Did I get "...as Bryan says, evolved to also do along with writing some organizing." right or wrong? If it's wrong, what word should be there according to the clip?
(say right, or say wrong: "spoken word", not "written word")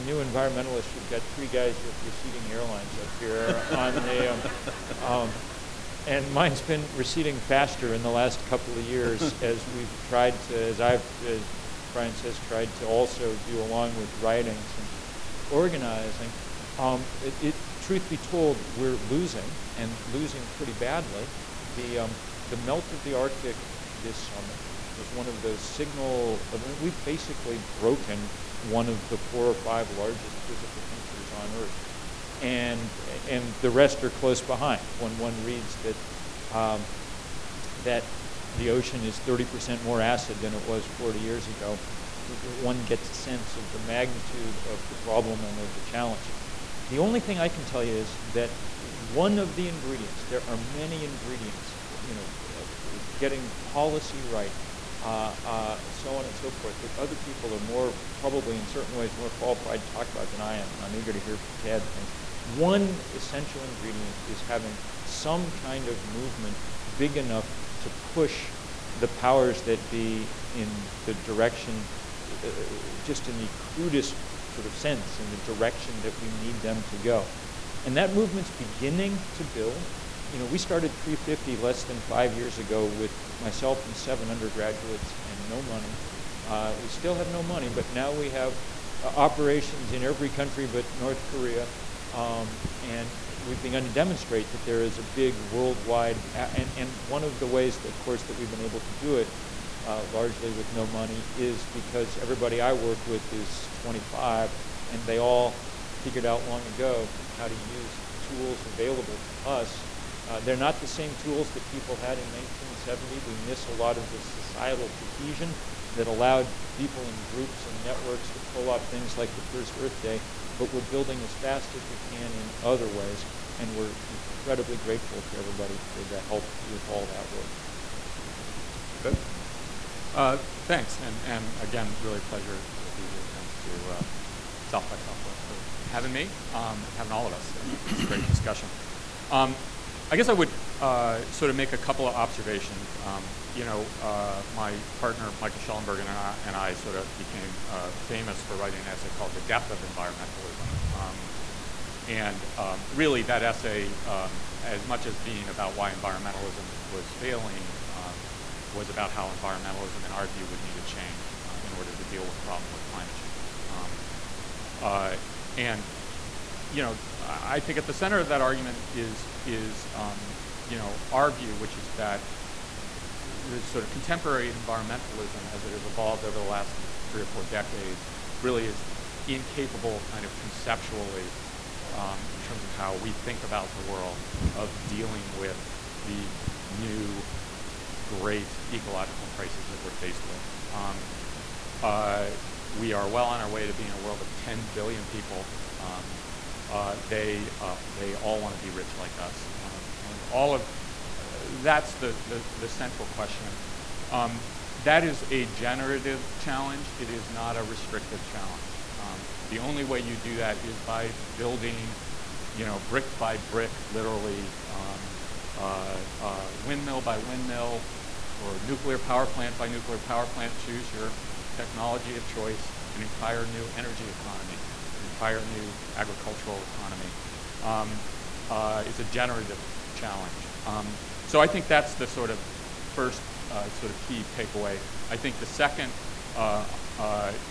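wrong: "tried", not "evolved".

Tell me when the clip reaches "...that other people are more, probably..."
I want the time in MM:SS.
00:56.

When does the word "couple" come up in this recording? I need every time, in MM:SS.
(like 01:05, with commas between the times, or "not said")
00:08, 02:21.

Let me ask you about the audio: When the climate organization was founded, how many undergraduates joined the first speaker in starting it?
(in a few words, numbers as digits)
7.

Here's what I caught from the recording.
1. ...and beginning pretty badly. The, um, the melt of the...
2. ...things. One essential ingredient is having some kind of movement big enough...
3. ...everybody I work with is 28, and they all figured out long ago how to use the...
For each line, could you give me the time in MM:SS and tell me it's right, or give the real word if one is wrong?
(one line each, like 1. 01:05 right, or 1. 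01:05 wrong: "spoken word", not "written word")
1. 00:19 wrong: "losing", not "beginning"
2. 01:01 right
3. 01:42 wrong: "25", not "28".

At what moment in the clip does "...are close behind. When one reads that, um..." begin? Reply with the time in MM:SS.
00:34.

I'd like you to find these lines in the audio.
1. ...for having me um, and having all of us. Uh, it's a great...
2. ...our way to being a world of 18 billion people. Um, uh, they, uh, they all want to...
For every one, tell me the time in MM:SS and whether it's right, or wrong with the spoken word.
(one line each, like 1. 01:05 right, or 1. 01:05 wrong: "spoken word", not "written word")
1. 02:15 right
2. 03:13 wrong: "10", not "18".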